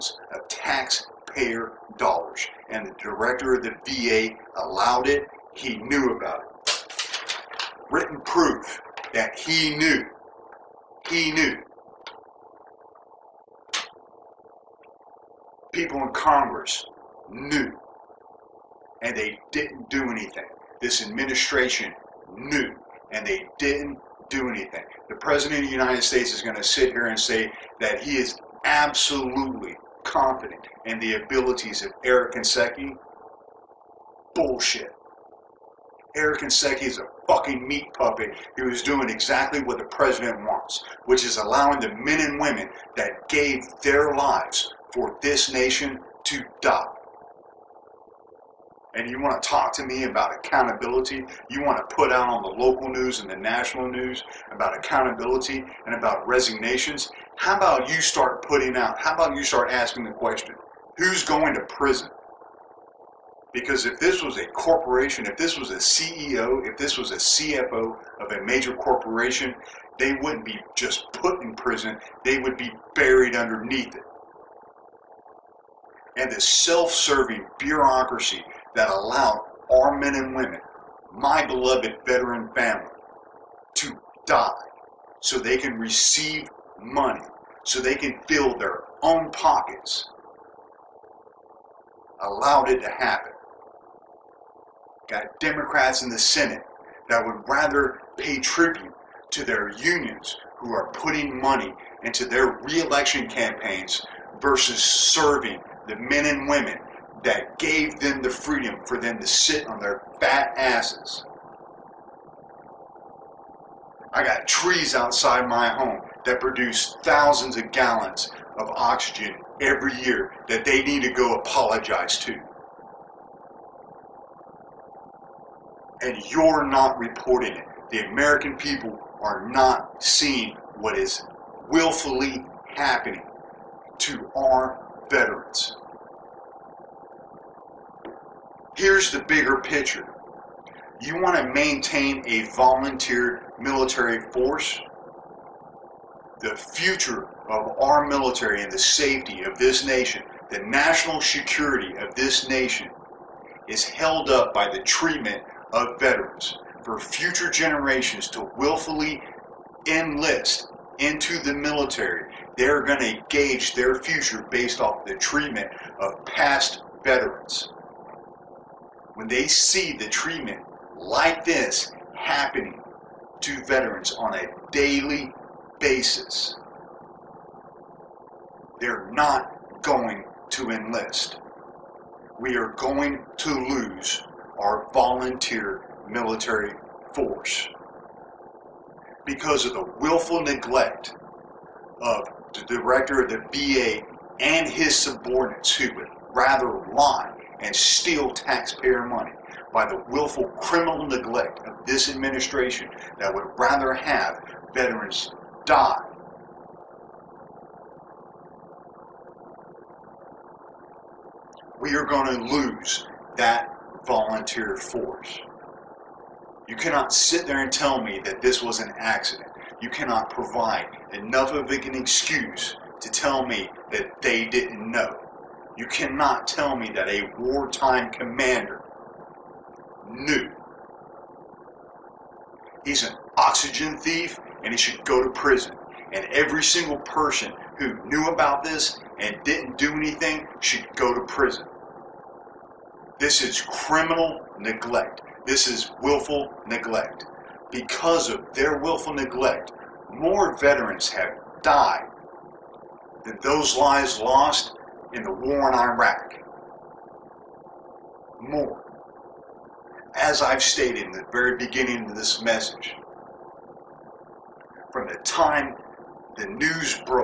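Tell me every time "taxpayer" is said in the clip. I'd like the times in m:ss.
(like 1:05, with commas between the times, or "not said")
0:00, 3:18.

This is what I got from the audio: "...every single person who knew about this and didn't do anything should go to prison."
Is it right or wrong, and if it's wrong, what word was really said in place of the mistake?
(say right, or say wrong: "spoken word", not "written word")
right.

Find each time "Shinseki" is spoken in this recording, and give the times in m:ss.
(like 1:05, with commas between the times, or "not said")
0:32, 0:36.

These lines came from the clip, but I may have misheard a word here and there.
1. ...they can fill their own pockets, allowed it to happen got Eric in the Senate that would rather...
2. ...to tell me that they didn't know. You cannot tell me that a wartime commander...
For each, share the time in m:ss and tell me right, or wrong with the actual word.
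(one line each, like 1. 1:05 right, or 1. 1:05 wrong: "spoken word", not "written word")
1. 1:27 wrong: "Democrats", not "Eric"
2. 3:43 right.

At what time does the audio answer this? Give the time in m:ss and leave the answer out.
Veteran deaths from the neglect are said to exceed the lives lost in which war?
4:15.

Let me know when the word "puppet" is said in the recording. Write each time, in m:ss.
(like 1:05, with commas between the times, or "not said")
0:37.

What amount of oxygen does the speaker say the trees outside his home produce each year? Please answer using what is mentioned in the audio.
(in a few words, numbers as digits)
Thousands of gallons.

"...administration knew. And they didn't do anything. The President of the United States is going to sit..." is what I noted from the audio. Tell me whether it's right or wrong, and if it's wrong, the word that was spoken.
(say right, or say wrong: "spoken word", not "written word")
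right.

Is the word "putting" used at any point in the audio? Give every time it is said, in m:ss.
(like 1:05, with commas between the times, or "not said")
0:58, 1:40.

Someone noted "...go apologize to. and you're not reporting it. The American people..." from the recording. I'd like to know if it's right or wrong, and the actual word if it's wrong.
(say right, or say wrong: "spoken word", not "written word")
right.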